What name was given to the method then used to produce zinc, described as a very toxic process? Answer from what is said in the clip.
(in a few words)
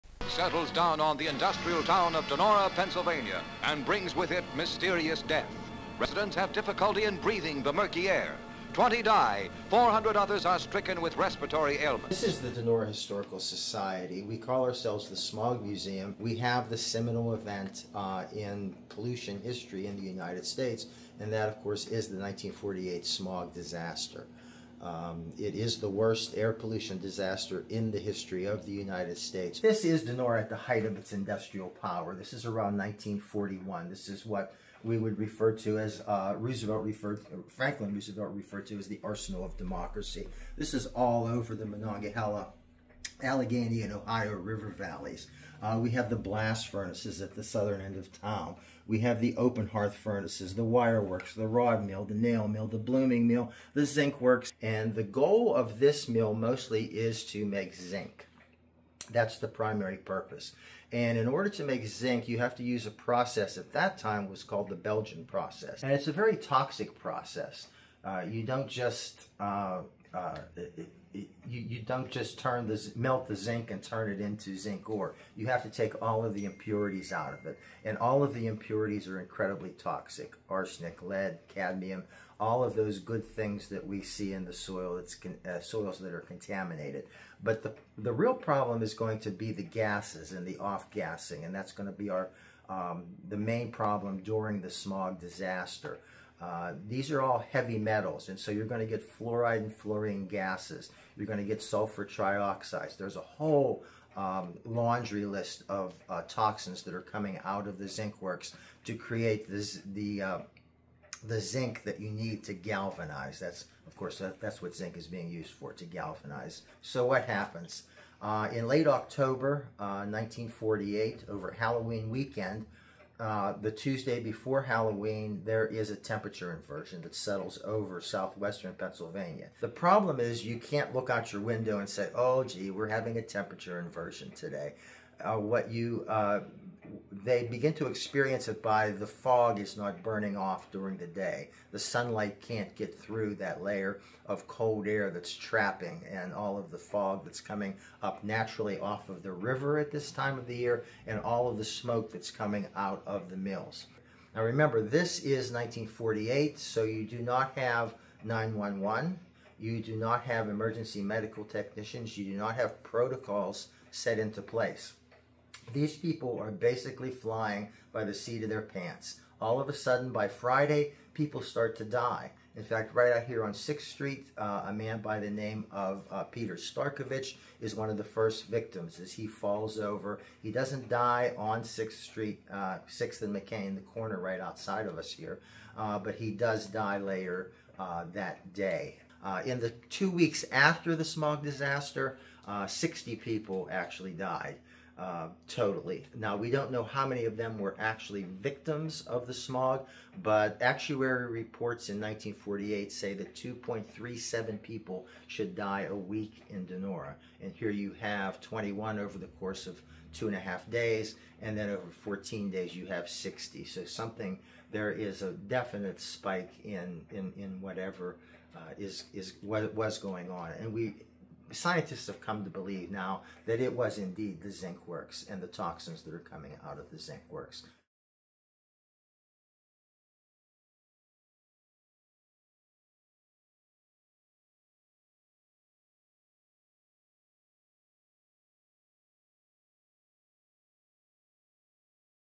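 Belgian process.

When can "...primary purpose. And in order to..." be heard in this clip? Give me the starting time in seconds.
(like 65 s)
59 s.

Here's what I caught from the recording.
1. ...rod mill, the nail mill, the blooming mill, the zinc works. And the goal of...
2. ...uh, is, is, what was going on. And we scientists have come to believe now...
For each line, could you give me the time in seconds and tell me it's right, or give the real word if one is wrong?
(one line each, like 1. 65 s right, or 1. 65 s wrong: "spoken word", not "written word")
1. 51 s right
2. 218 s right.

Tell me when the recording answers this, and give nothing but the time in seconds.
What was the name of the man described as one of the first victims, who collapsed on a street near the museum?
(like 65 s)
176 s.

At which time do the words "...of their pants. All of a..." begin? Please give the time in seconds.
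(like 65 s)
168 s.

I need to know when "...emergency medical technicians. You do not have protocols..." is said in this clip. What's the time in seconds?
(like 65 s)
160 s.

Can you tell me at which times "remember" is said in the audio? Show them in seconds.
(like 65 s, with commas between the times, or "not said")
154 s.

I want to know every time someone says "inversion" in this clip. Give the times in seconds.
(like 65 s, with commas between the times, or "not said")
126 s, 133 s.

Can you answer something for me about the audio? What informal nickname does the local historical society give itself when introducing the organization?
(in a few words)
Smog Museum.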